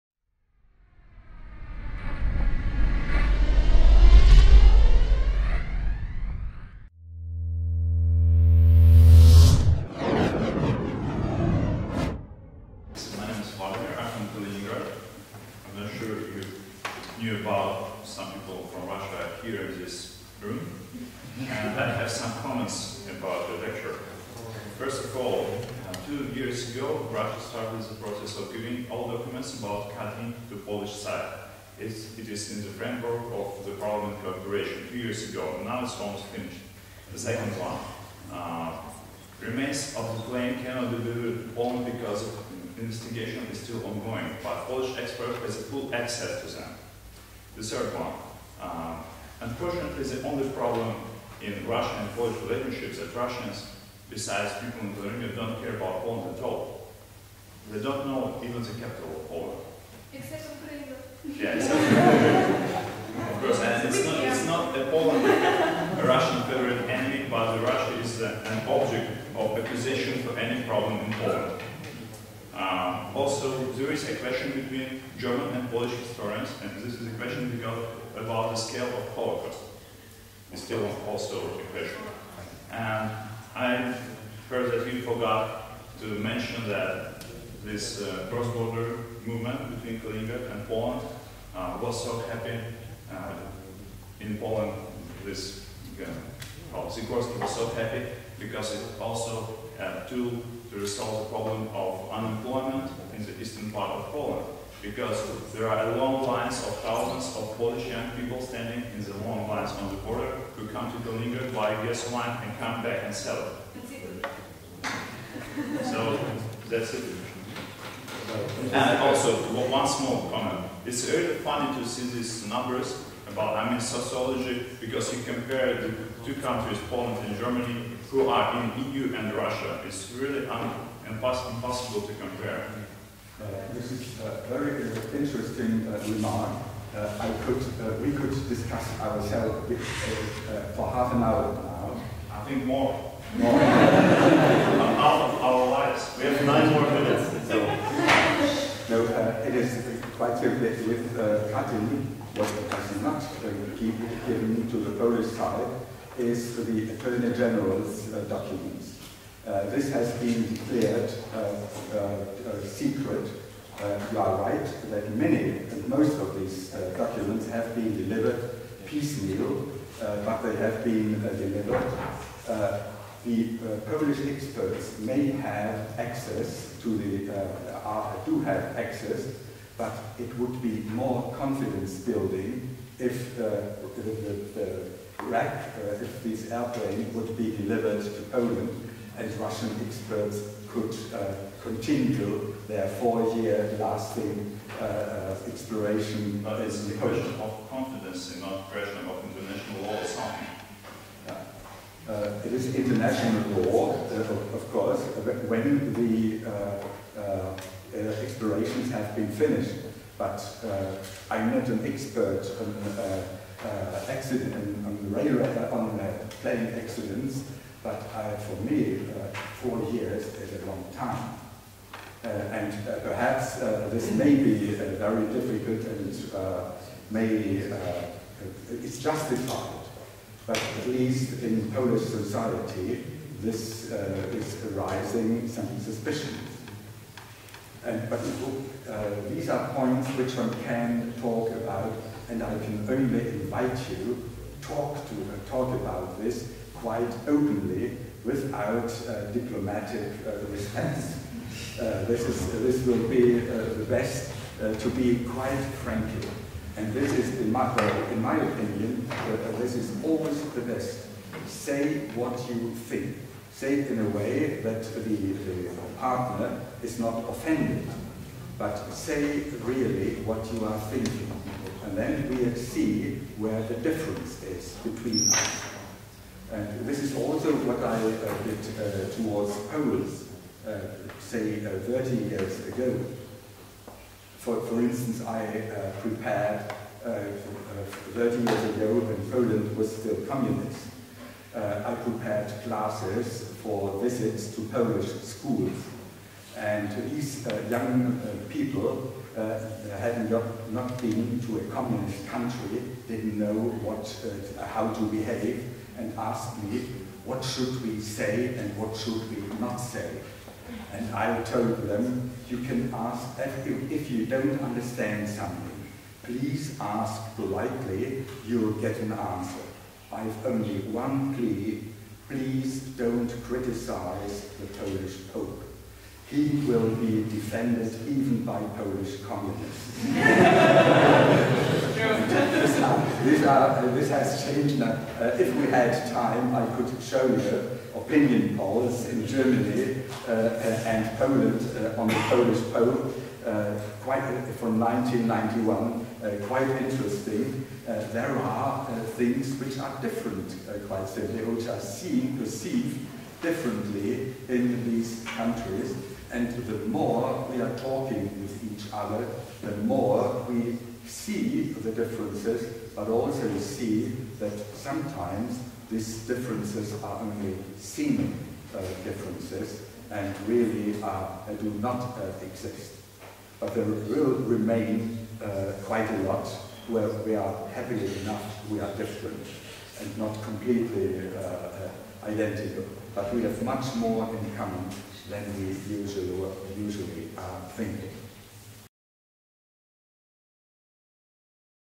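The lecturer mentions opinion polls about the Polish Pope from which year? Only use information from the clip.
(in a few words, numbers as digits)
1991.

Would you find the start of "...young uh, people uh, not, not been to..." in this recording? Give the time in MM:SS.
04:57.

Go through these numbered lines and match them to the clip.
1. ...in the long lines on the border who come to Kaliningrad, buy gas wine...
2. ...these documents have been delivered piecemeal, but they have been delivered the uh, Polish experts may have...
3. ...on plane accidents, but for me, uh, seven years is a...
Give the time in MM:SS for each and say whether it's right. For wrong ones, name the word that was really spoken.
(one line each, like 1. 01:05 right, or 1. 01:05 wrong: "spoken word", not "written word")
1. 01:48 right
2. 02:46 right
3. 03:35 wrong: "four", not "seven".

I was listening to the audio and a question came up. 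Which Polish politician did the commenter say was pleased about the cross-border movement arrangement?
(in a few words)
Sikorski.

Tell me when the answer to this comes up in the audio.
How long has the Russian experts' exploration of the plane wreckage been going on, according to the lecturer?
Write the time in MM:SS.
03:12.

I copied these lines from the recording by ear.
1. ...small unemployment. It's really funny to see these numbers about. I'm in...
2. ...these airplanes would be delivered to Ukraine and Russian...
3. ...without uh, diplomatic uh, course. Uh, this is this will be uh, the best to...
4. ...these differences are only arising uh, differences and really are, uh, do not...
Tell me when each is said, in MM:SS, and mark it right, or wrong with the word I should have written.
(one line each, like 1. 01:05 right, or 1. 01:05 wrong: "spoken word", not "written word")
1. 01:59 wrong: "comment", not "unemployment"
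2. 03:06 wrong: "Poland", not "Ukraine"
3. 04:08 wrong: "response", not "course"
4. 06:05 wrong: "seeming", not "arising".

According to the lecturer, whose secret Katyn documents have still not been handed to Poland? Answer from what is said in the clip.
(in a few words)
The Attorney General's.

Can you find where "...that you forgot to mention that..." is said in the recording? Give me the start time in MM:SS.
01:24.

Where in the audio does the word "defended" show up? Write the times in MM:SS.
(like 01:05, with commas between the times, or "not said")
05:27.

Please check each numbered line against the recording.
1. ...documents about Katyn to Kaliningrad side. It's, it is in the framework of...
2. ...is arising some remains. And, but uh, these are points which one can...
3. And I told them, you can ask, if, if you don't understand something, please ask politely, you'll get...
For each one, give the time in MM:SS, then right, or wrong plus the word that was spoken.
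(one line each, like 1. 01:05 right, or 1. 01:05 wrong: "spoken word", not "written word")
1. 00:29 wrong: "Polish", not "Kaliningrad"
2. 03:54 wrong: "suspicions", not "remains"
3. 05:10 right.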